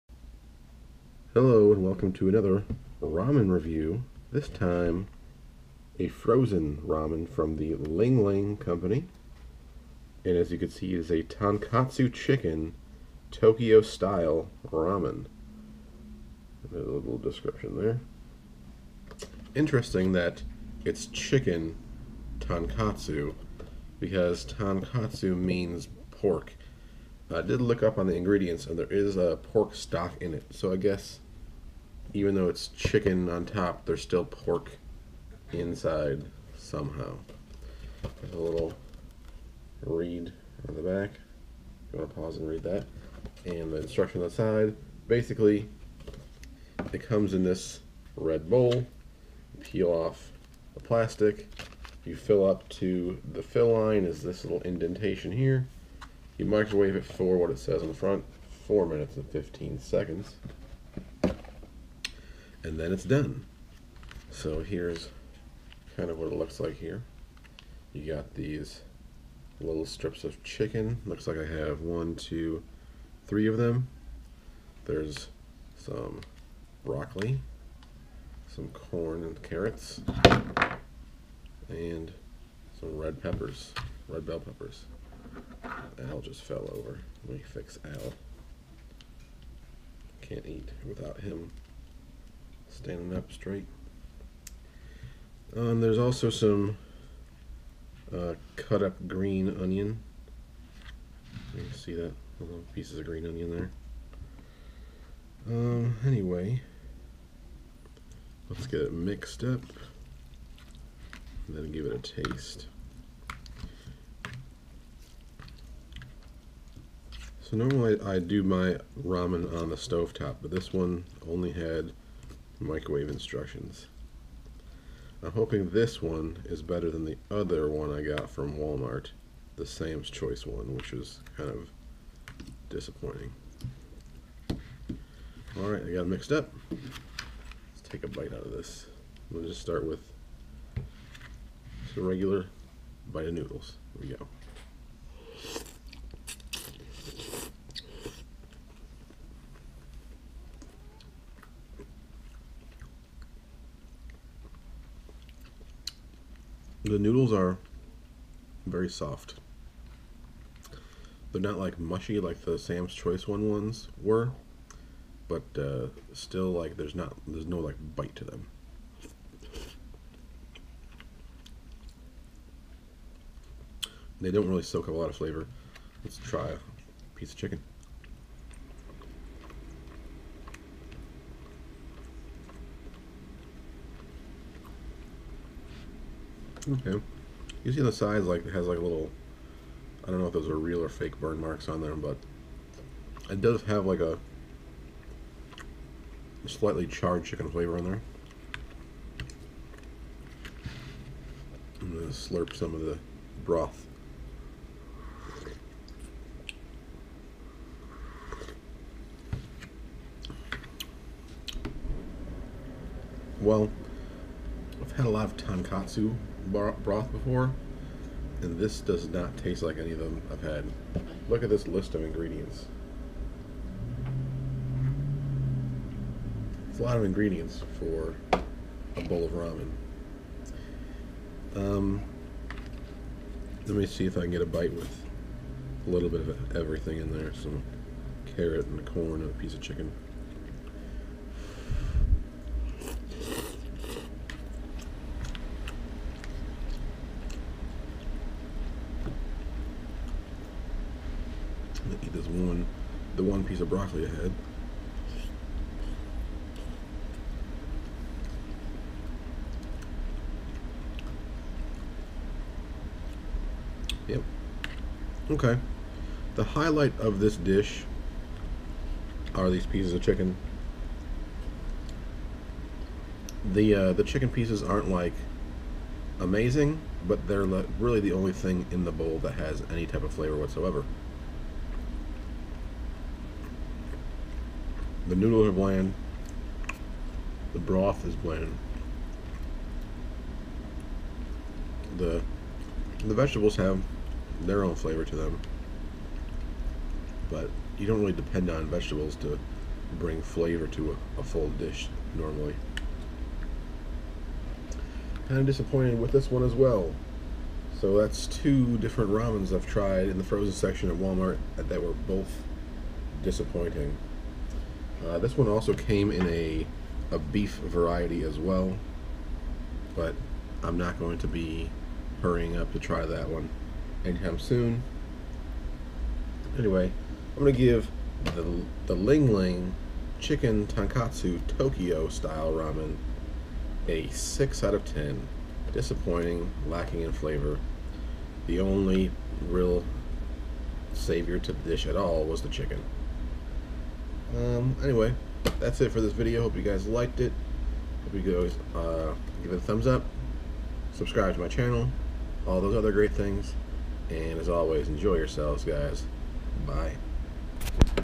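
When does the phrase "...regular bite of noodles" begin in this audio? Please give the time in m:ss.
2:22.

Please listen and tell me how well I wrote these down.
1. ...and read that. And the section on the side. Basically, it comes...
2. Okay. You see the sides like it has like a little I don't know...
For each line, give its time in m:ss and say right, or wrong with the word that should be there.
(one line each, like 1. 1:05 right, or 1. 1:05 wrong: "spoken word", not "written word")
1. 0:42 wrong: "instruction", not "section"
2. 3:06 right.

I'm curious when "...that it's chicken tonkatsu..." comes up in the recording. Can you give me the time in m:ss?
0:20.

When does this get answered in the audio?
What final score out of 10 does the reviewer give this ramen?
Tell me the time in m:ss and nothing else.
5:34.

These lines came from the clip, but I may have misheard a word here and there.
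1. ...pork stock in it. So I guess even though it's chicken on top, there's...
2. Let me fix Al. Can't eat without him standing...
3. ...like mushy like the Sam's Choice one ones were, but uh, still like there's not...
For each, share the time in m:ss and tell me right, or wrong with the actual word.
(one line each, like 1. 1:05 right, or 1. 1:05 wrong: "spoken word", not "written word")
1. 0:29 right
2. 1:27 right
3. 2:41 right.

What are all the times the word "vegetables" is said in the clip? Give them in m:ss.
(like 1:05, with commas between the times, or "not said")
4:53, 4:58.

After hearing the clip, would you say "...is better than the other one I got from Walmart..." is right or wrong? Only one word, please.
right.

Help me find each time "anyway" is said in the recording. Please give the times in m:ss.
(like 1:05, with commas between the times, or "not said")
1:46, 5:26, 5:44.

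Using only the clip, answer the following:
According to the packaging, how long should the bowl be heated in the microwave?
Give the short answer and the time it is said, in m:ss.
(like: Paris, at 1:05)
4 minutes and 15 seconds, at 0:58.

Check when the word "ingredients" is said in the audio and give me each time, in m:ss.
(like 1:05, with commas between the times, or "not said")
0:28, 3:42, 3:47.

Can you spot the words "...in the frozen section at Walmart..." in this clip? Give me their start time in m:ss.
5:10.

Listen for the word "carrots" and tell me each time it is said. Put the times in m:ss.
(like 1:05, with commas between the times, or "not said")
1:19, 3:58.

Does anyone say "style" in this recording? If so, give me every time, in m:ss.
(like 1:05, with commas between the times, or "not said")
0:13, 5:32.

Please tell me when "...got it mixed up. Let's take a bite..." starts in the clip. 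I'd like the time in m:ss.
2:15.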